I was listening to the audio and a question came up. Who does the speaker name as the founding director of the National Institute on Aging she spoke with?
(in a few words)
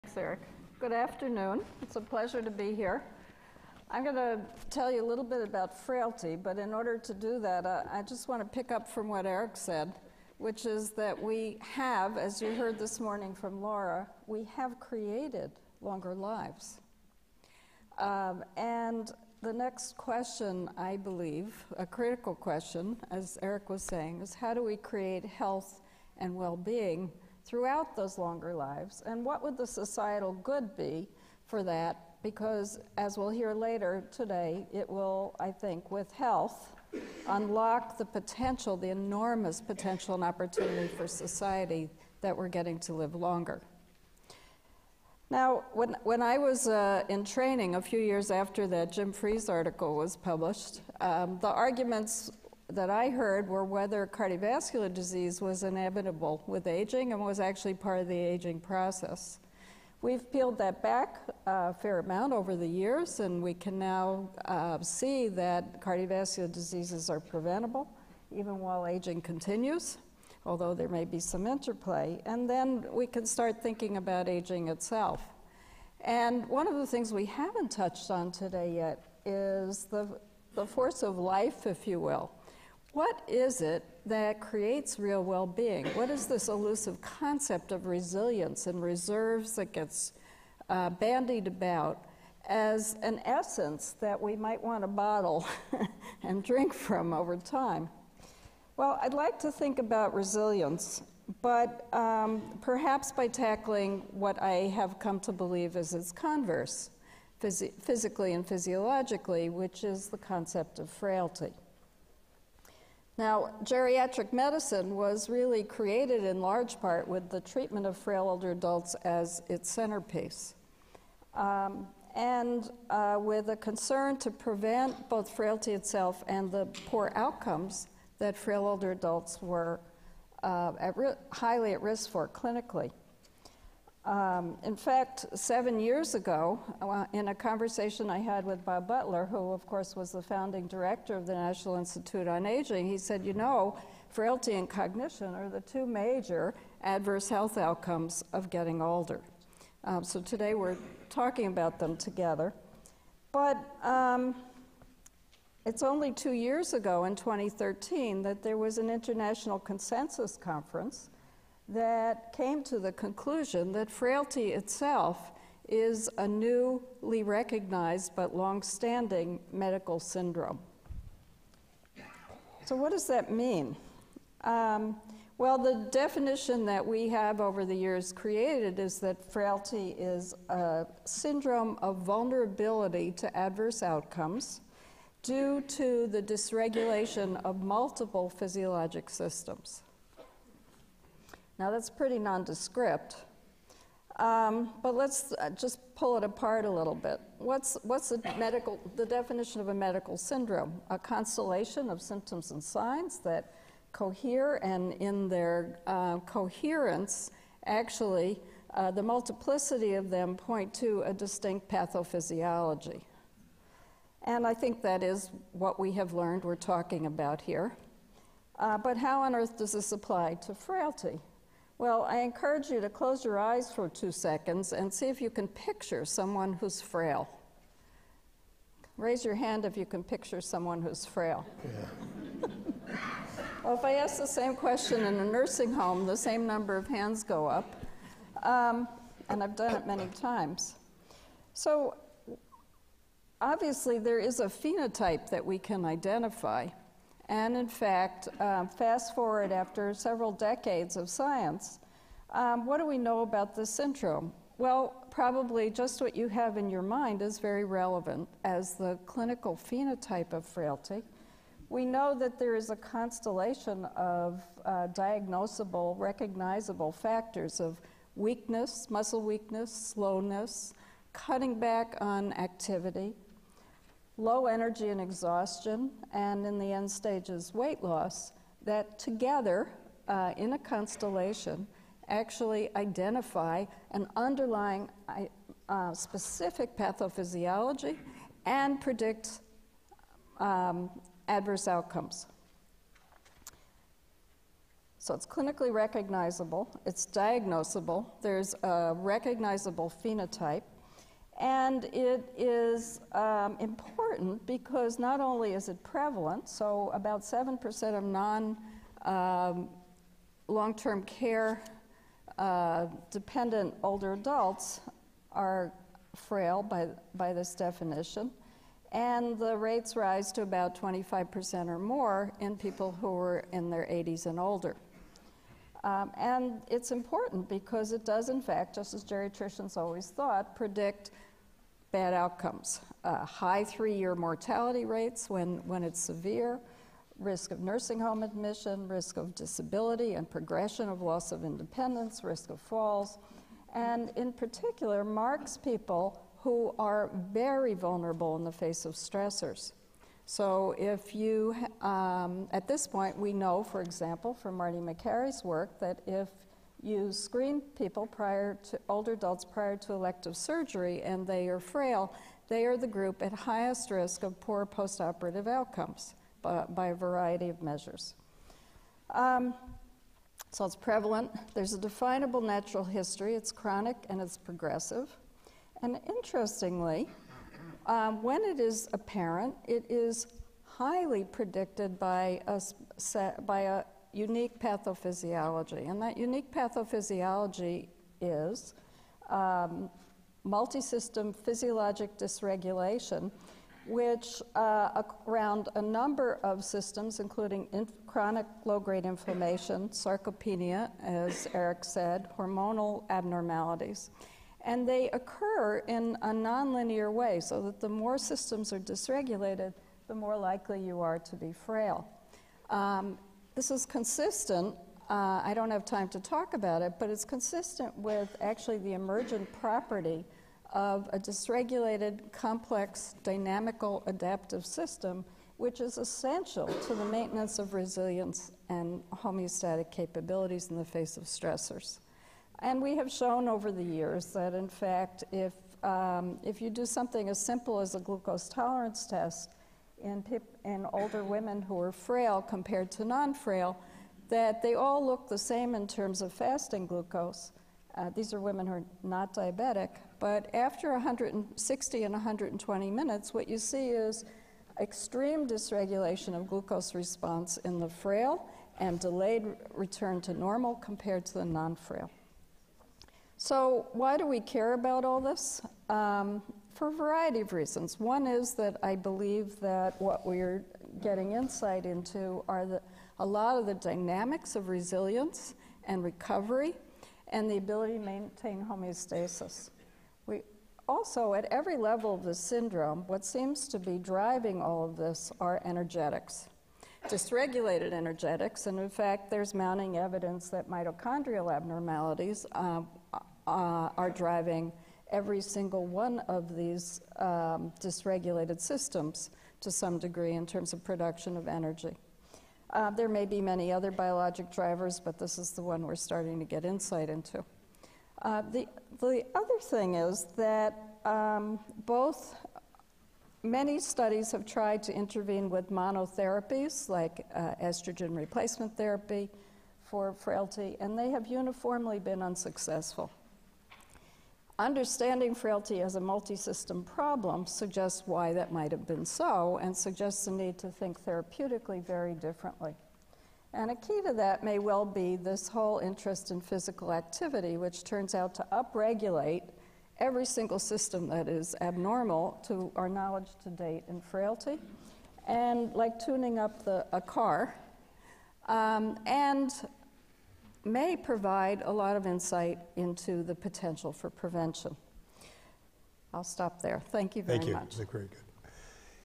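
Bob Butler.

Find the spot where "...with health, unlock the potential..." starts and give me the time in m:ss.
0:35.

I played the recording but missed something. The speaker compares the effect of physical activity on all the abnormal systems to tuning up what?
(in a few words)
a car.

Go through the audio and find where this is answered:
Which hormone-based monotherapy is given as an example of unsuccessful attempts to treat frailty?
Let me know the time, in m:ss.
8:37.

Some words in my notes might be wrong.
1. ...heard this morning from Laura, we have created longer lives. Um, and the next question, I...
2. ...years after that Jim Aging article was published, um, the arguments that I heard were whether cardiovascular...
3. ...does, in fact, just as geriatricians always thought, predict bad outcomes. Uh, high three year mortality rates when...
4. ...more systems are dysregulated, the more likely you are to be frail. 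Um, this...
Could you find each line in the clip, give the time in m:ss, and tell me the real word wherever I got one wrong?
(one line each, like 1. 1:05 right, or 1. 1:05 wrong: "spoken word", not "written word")
1. 0:12 right
2. 0:47 wrong: "Fries", not "Aging"
3. 5:28 right
4. 6:47 right.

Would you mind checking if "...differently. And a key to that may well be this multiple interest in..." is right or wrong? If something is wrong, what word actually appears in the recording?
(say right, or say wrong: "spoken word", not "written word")
wrong: "whole", not "multiple".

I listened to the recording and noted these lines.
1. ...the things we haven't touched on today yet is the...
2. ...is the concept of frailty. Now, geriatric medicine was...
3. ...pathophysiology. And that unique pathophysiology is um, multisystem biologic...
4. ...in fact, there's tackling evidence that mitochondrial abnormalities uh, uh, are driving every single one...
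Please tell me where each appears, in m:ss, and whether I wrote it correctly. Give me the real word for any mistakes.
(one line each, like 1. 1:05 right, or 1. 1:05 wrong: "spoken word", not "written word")
1. 1:16 right
2. 1:49 right
3. 6:24 wrong: "physiologic", not "biologic"
4. 8:08 wrong: "mounting", not "tackling".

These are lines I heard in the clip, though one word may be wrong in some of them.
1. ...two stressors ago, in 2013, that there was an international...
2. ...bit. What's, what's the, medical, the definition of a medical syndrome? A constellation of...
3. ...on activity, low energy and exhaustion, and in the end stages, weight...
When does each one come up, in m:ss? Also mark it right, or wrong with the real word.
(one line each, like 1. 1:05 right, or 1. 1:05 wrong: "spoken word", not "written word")
1. 2:36 wrong: "years", not "stressors"
2. 3:16 right
3. 4:32 right.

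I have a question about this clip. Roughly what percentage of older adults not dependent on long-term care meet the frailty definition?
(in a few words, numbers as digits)
7%.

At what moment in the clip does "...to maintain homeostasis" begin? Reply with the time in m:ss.
7:57.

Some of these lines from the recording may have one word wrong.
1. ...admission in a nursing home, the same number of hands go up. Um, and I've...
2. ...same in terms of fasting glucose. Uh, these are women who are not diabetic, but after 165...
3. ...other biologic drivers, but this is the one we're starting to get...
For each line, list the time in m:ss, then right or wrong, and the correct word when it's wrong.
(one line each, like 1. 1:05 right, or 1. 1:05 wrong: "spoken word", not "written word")
1. 3:54 wrong: "question", not "admission"
2. 7:25 wrong: "160", not "165"
3. 8:23 right.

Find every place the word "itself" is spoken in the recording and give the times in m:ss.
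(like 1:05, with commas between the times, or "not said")
1:14, 2:05, 2:44.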